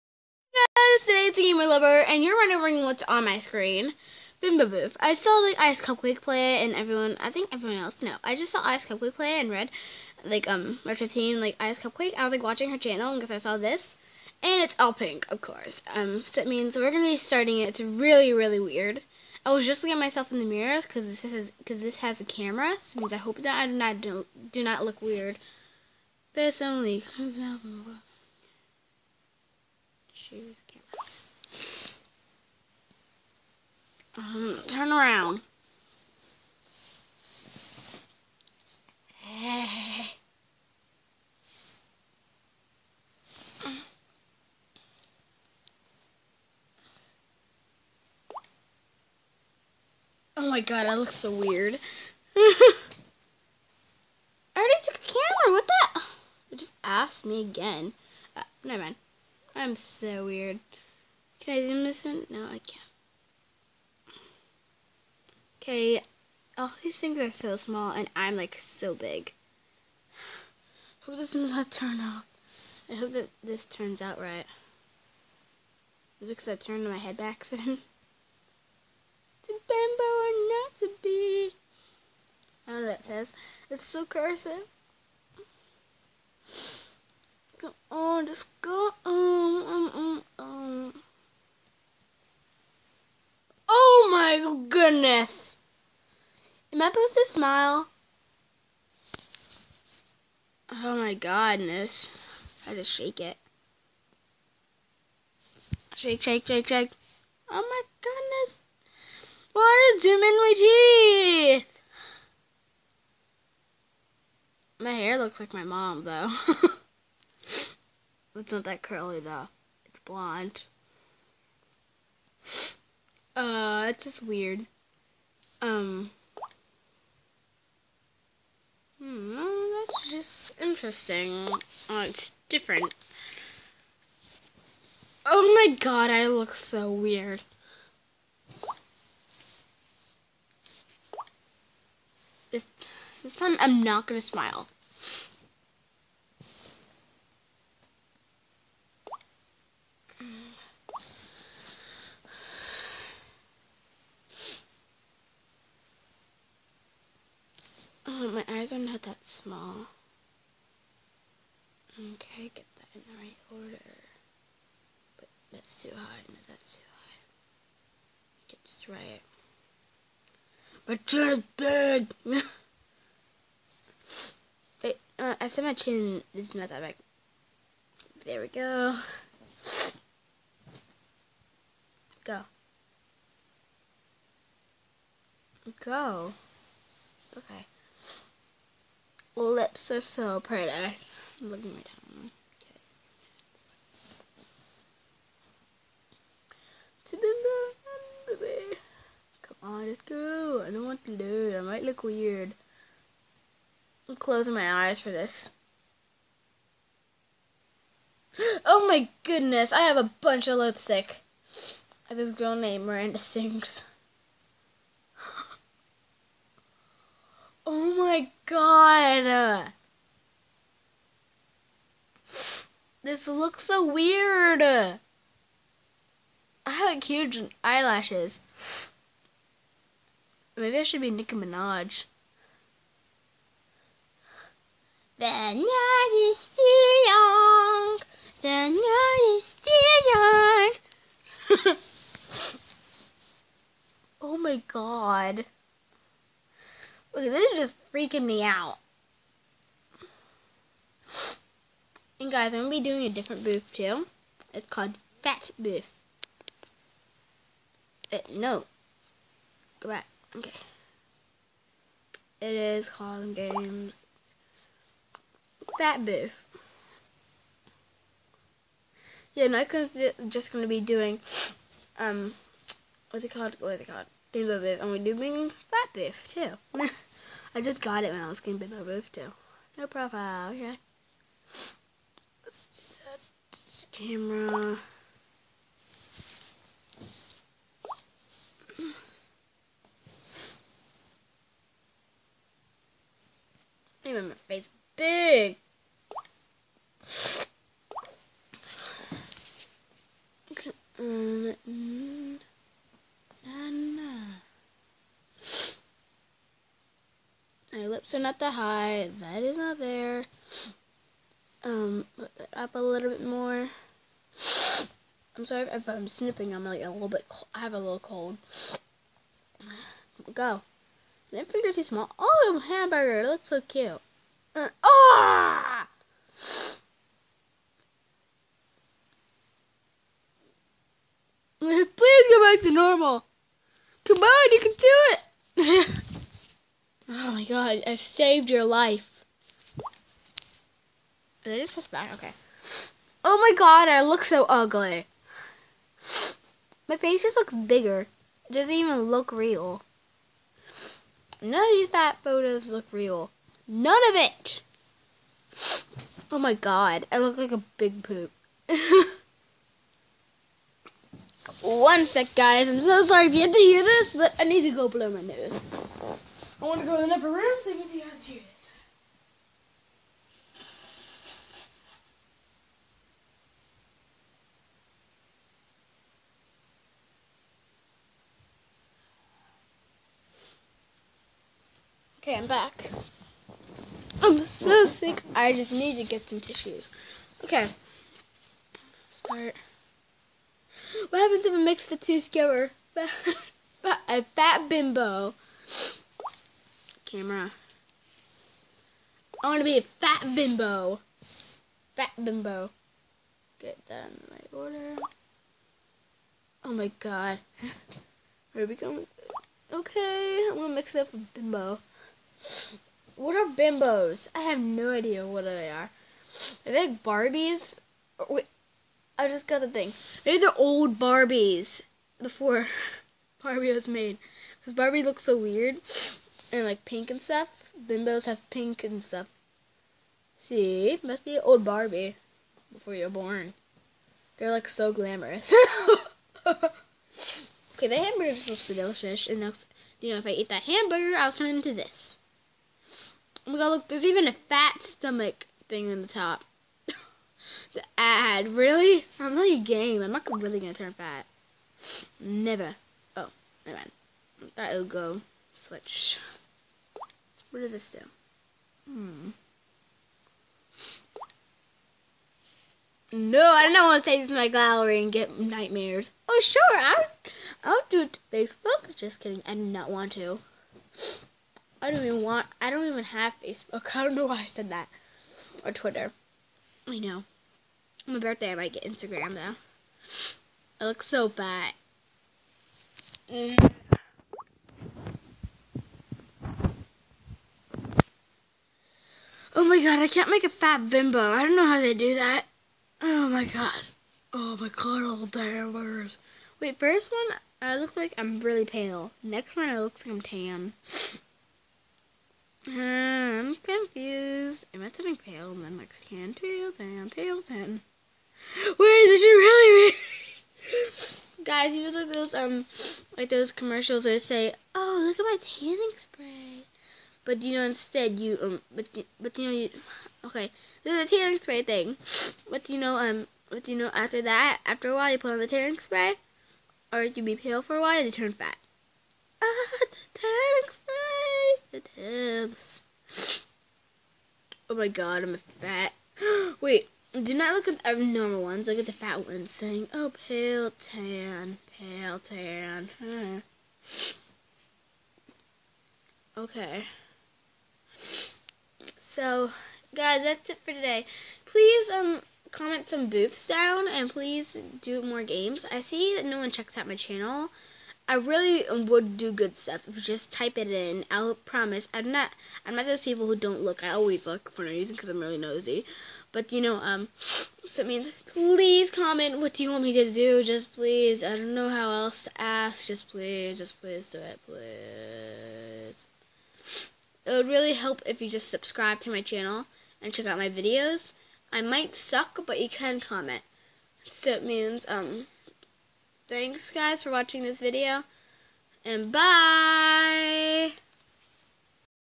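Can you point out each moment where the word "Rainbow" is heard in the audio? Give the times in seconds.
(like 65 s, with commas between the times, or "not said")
274 s, 278 s.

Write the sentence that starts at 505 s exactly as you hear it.
And then like tan, pale, tan, pale, tan.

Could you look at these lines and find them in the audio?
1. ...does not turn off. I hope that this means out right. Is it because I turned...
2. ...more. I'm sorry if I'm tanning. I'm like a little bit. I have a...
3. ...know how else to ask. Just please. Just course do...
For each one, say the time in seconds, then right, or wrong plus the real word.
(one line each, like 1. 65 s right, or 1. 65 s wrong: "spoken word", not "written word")
1. 71 s wrong: "turns", not "means"
2. 313 s wrong: "snipping", not "tanning"
3. 571 s wrong: "please", not "course".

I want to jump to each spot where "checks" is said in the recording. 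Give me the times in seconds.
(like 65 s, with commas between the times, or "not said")
556 s, 580 s.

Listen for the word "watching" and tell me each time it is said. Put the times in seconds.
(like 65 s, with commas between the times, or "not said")
12 s, 587 s.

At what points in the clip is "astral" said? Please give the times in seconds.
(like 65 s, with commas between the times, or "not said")
not said.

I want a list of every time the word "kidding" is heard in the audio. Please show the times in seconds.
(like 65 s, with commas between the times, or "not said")
469 s.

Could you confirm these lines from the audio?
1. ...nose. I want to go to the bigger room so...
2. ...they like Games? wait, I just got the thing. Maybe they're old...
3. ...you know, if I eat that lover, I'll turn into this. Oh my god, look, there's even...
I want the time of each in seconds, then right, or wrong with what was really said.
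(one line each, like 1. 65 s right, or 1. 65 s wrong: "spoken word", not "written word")
1. 365 s wrong: "upper", not "bigger"
2. 416 s wrong: "Barbies", not "Games"
3. 439 s wrong: "hamburger", not "lover".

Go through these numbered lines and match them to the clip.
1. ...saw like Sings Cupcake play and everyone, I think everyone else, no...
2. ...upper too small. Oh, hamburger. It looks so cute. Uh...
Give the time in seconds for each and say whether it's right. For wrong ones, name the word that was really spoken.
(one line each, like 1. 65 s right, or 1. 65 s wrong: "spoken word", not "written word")
1. 5 s wrong: "Ice", not "Sings"
2. 321 s wrong: "finger", not "upper".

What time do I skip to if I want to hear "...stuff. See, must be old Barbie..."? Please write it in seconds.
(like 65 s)
429 s.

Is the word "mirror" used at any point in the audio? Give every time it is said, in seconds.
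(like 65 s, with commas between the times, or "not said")
20 s.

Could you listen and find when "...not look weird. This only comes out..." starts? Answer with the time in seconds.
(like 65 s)
24 s.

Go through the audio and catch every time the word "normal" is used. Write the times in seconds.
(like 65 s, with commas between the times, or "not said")
332 s, 538 s.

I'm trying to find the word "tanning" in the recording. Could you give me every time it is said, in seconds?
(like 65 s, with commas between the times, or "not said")
515 s, 521 s, 525 s, 530 s.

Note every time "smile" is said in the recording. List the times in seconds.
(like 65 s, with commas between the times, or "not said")
97 s, 144 s.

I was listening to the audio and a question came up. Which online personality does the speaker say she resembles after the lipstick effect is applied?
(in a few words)
Miranda Sings.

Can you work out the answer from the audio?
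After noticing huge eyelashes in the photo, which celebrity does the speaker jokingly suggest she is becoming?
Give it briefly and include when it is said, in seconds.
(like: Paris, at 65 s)
Nicki Minaj, at 231 s.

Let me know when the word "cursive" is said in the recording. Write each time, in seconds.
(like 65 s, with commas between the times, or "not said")
84 s.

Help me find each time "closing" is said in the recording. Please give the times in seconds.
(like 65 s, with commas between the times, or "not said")
204 s.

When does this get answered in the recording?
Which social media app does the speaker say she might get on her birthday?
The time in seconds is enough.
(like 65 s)
478 s.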